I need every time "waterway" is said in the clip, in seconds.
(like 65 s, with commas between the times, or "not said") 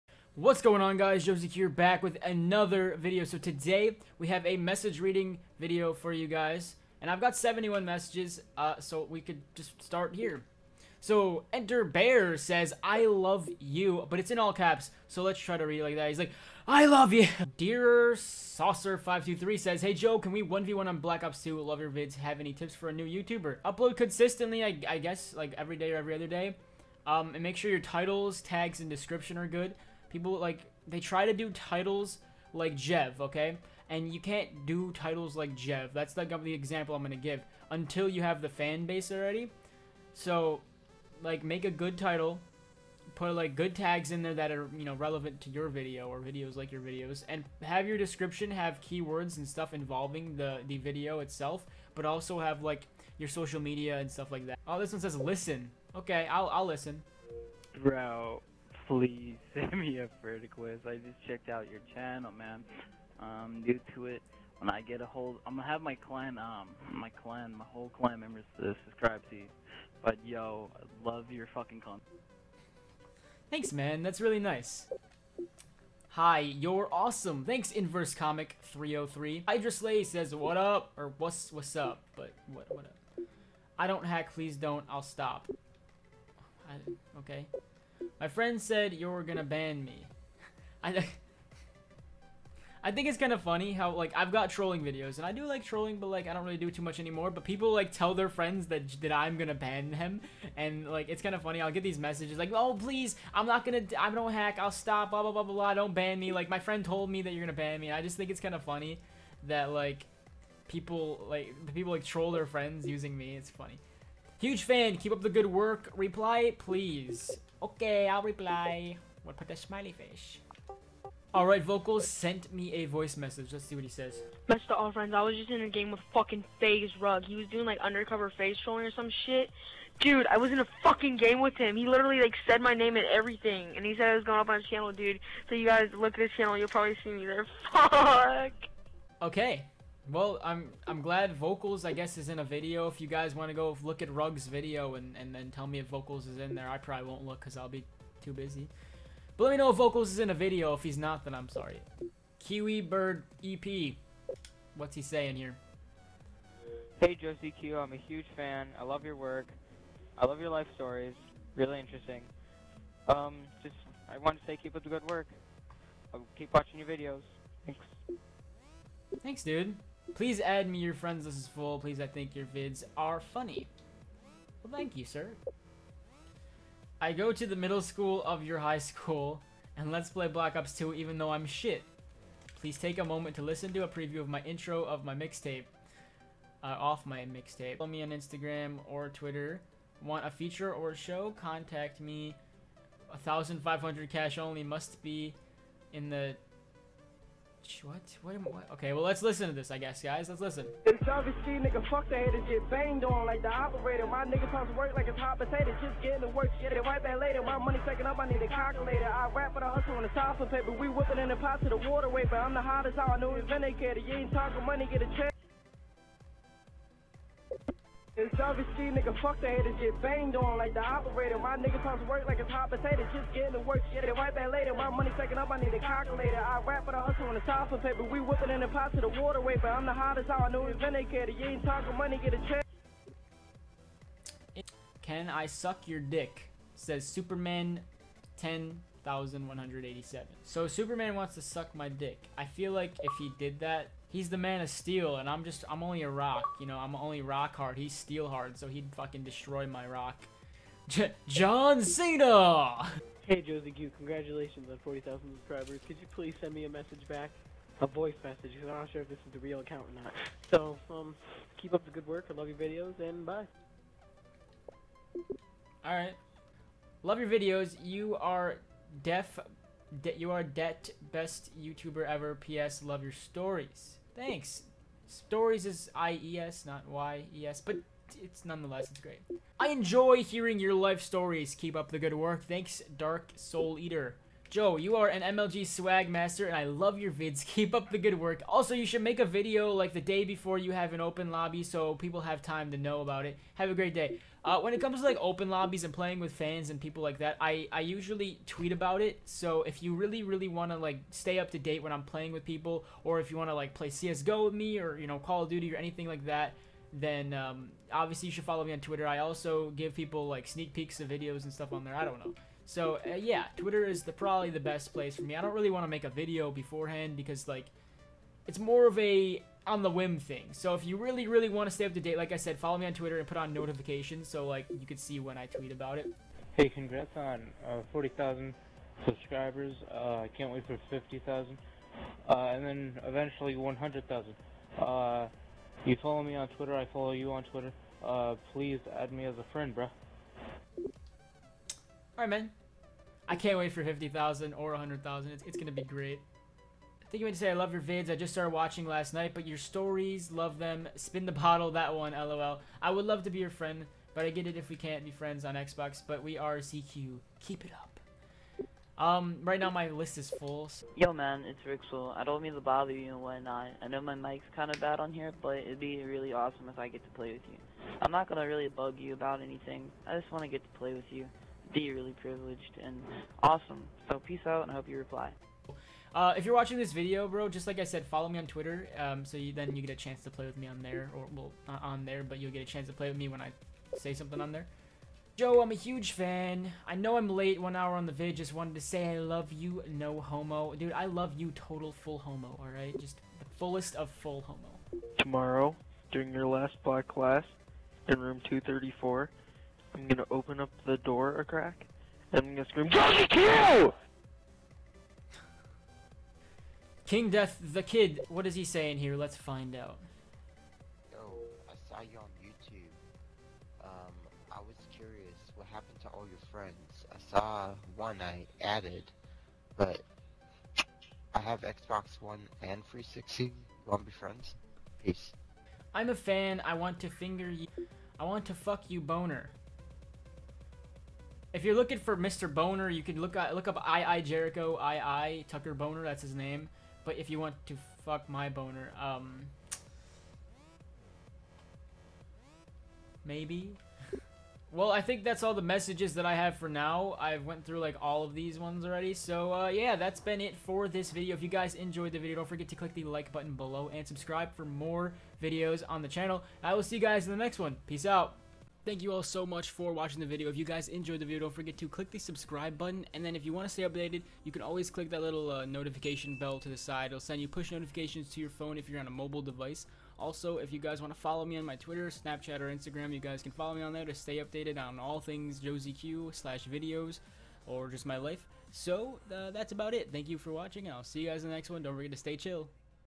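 211 s, 229 s.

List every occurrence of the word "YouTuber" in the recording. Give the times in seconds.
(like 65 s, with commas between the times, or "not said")
23 s, 271 s.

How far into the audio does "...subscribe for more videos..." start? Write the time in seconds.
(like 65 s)
454 s.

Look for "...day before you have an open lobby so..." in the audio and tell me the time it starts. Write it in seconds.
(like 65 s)
290 s.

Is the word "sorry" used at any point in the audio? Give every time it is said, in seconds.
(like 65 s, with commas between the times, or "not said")
151 s.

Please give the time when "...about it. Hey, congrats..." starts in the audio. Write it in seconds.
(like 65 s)
325 s.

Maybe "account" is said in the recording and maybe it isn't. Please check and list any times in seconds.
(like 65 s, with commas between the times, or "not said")
259 s.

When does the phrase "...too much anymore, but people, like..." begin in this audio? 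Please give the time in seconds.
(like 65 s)
96 s.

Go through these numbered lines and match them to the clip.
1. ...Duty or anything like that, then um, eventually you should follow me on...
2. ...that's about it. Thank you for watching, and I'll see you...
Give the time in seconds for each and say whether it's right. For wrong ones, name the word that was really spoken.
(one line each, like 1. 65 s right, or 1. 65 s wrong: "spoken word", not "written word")
1. 305 s wrong: "obviously", not "eventually"
2. 479 s right.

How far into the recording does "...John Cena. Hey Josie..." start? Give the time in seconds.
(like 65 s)
251 s.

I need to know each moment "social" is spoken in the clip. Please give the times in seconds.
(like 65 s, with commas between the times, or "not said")
53 s.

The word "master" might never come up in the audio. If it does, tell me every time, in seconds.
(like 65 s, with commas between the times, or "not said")
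286 s.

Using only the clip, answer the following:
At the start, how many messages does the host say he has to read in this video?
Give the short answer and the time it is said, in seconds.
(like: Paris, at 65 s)
71, at 7 s.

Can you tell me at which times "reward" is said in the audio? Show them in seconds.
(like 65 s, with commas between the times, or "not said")
not said.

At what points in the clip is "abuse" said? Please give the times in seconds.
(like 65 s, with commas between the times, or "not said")
not said.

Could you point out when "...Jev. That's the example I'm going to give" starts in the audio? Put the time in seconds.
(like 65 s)
35 s.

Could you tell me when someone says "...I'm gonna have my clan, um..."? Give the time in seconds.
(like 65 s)
65 s.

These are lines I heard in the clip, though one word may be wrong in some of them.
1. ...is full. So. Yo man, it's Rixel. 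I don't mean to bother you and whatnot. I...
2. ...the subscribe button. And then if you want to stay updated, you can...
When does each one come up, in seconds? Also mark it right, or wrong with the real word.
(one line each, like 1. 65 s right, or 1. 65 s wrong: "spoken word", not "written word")
1. 360 s right
2. 462 s right.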